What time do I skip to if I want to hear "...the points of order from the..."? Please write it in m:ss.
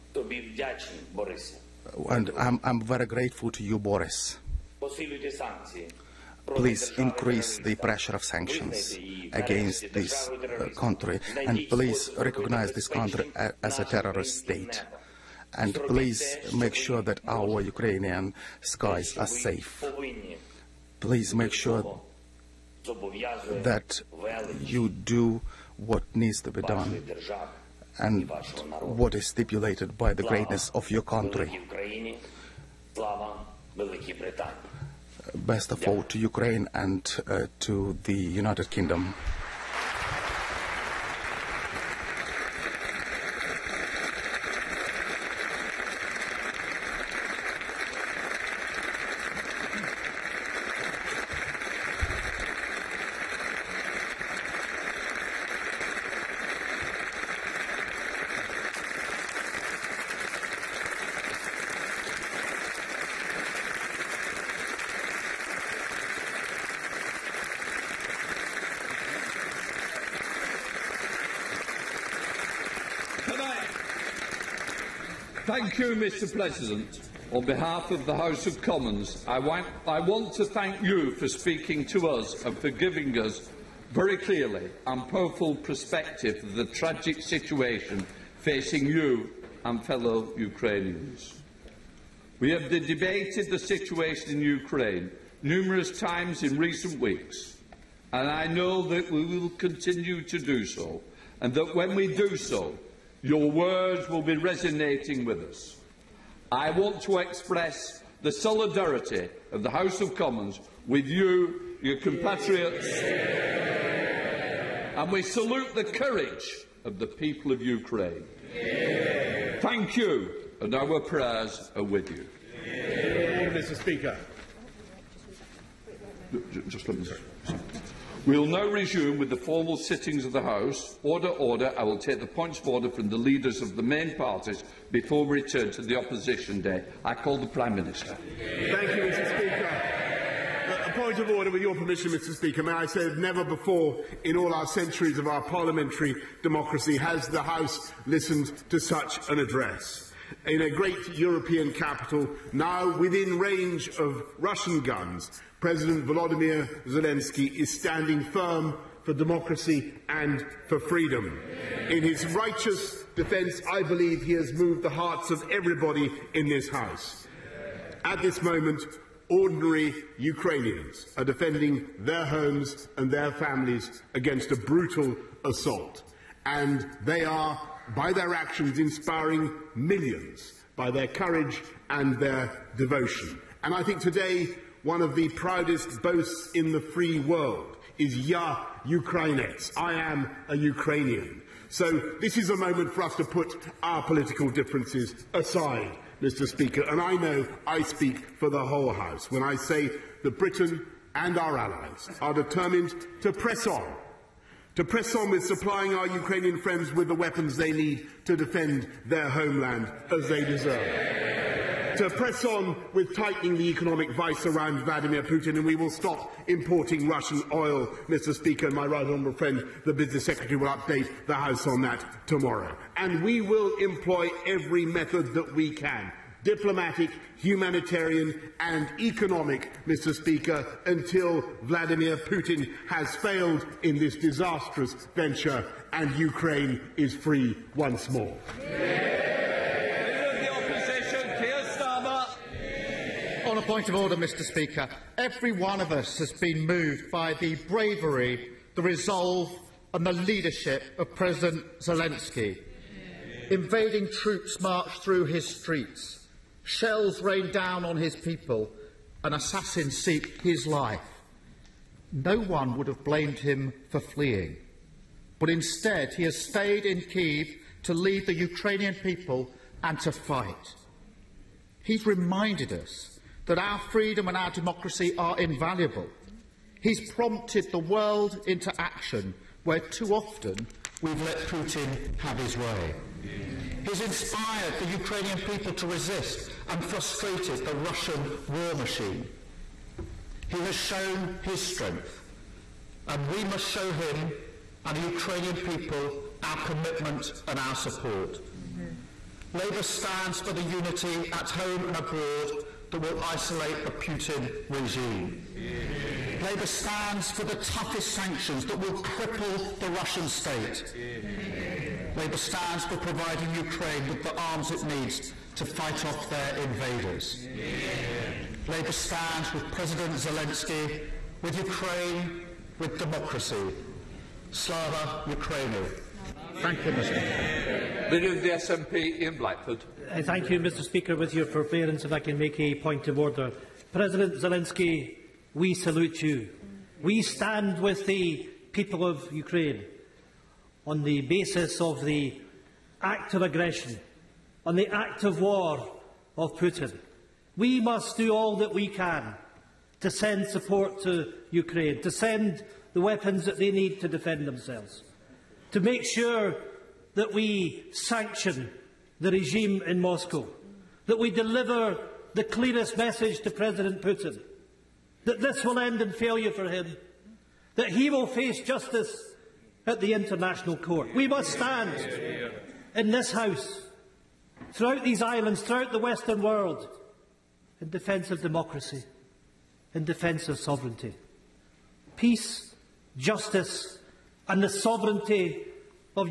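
2:12.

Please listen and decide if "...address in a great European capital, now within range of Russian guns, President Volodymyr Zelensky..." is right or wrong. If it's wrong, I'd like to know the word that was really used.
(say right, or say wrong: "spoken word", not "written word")
right.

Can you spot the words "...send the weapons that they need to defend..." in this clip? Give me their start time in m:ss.
5:52.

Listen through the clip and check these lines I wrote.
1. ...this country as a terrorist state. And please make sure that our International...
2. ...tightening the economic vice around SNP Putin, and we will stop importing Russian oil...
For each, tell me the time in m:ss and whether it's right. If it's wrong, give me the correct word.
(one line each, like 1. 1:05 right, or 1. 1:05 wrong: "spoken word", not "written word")
1. 0:12 wrong: "Ukrainian", not "International"
2. 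3:33 wrong: "Vladimir", not "SNP".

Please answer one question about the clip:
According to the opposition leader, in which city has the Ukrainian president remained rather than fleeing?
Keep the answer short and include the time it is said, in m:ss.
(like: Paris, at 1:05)
Kiev, at 4:27.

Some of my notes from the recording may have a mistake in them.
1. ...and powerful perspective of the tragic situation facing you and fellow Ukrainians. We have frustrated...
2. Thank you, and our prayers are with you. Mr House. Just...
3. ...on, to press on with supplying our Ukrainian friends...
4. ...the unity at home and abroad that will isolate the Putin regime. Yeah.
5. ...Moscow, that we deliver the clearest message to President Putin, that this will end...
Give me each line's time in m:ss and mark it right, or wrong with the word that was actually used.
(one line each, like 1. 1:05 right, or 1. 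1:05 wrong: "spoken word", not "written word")
1. 1:24 wrong: "debated", not "frustrated"
2. 1:59 wrong: "Speaker", not "House"
3. 3:23 right
4. 5:00 right
5. 5:59 right.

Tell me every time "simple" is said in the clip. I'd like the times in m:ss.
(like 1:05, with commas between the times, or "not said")
not said.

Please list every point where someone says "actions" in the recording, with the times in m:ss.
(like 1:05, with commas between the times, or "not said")
2:58, 4:38.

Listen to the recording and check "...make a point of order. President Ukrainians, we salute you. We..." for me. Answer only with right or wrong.
wrong.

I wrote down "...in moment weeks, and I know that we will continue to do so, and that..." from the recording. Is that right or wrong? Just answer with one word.
wrong.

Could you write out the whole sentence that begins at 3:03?
And I think today one of the proudest boasts in the free world is Ya Ukrainets.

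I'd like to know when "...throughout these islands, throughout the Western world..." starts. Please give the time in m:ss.
6:14.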